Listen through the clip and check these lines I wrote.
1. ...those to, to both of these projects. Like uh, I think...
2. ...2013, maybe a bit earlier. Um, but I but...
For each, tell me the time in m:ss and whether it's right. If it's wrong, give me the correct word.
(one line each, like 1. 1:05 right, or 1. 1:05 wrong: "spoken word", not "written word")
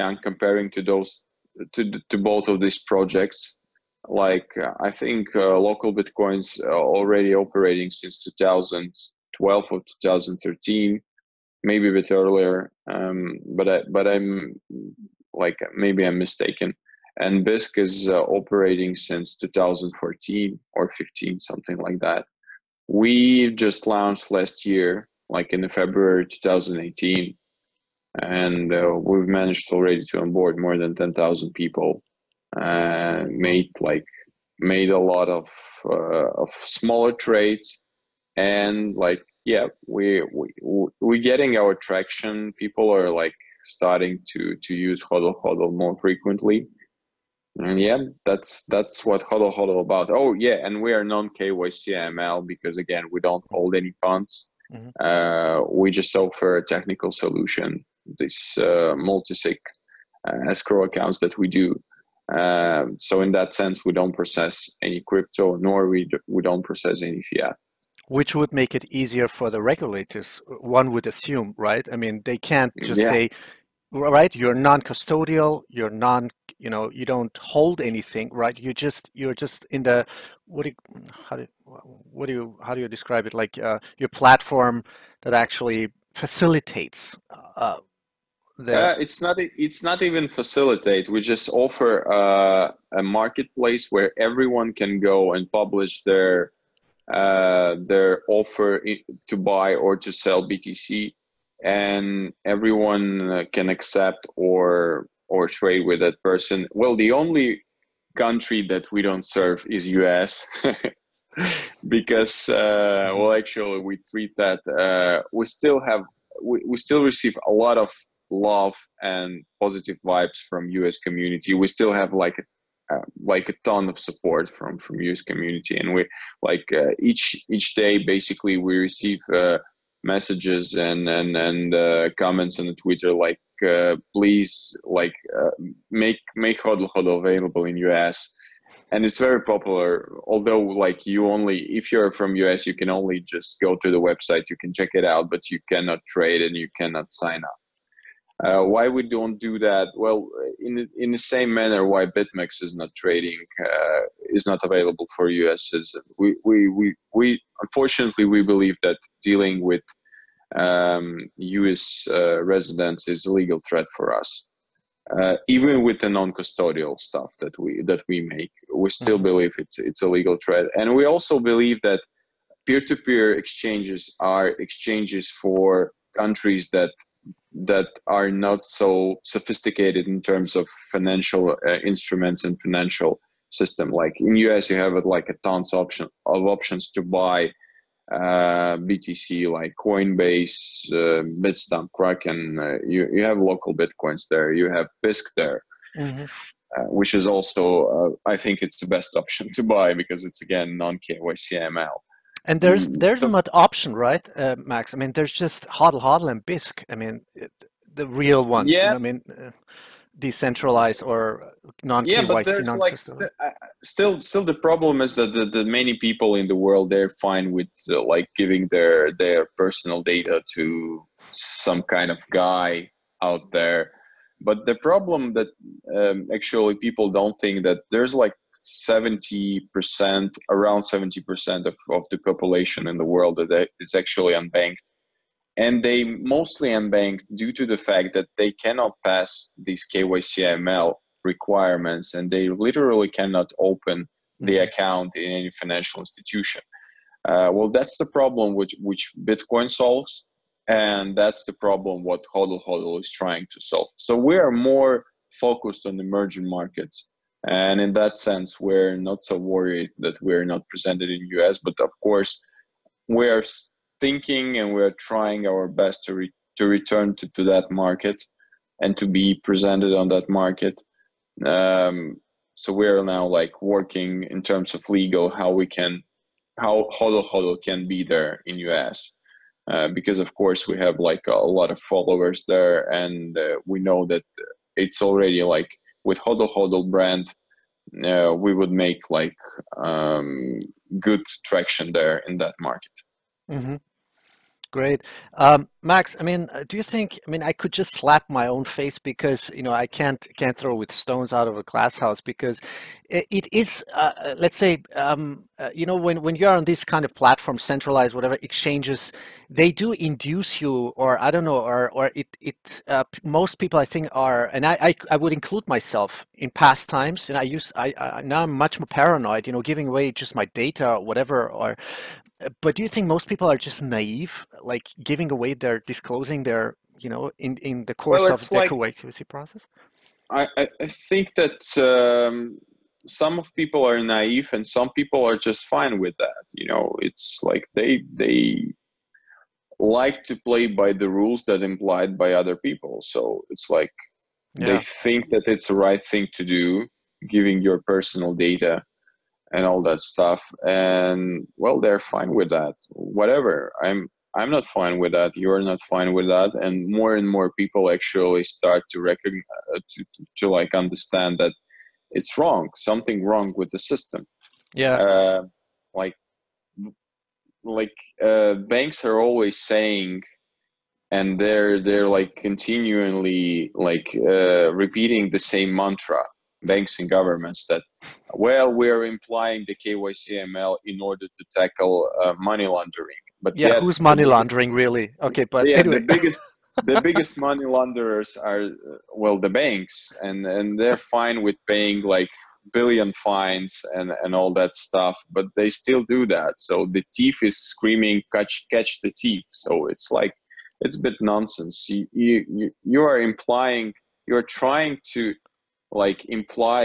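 1. 0:00 right
2. 0:10 right.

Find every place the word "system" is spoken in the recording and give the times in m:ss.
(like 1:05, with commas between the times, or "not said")
3:03, 6:03.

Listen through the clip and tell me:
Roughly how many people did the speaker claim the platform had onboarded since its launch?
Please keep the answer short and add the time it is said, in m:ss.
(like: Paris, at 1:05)
more than 10,000, at 0:30.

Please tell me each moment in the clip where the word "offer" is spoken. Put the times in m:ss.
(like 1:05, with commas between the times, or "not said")
0:56, 1:31, 1:38.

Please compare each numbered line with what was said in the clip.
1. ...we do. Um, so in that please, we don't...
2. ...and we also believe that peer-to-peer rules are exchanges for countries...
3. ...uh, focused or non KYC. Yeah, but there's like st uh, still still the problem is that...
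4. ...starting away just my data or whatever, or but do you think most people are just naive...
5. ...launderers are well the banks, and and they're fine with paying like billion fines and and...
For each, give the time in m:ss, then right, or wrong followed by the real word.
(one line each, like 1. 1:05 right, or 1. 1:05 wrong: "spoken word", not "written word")
1. 1:01 wrong: "sense", not "please"
2. 2:50 wrong: "exchanges", not "rules"
3. 3:29 wrong: "decentralized", not "focused"
4. 5:19 wrong: "giving", not "starting"
5. 6:27 right.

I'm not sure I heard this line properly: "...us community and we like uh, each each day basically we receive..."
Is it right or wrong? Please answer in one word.
right.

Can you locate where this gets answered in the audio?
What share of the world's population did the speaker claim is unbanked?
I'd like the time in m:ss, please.
3:50.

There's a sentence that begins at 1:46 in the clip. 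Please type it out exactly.
Well, the only country that we don't serve is US.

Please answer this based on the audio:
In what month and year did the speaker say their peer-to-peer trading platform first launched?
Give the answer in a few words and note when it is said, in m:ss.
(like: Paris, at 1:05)
February 2018, at 0:25.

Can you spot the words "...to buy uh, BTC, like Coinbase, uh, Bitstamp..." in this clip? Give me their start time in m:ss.
3:06.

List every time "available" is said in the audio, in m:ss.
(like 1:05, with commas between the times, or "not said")
2:17, 2:34.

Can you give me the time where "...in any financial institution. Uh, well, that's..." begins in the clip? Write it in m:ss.
4:05.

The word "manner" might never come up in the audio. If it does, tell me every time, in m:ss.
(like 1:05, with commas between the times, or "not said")
2:31.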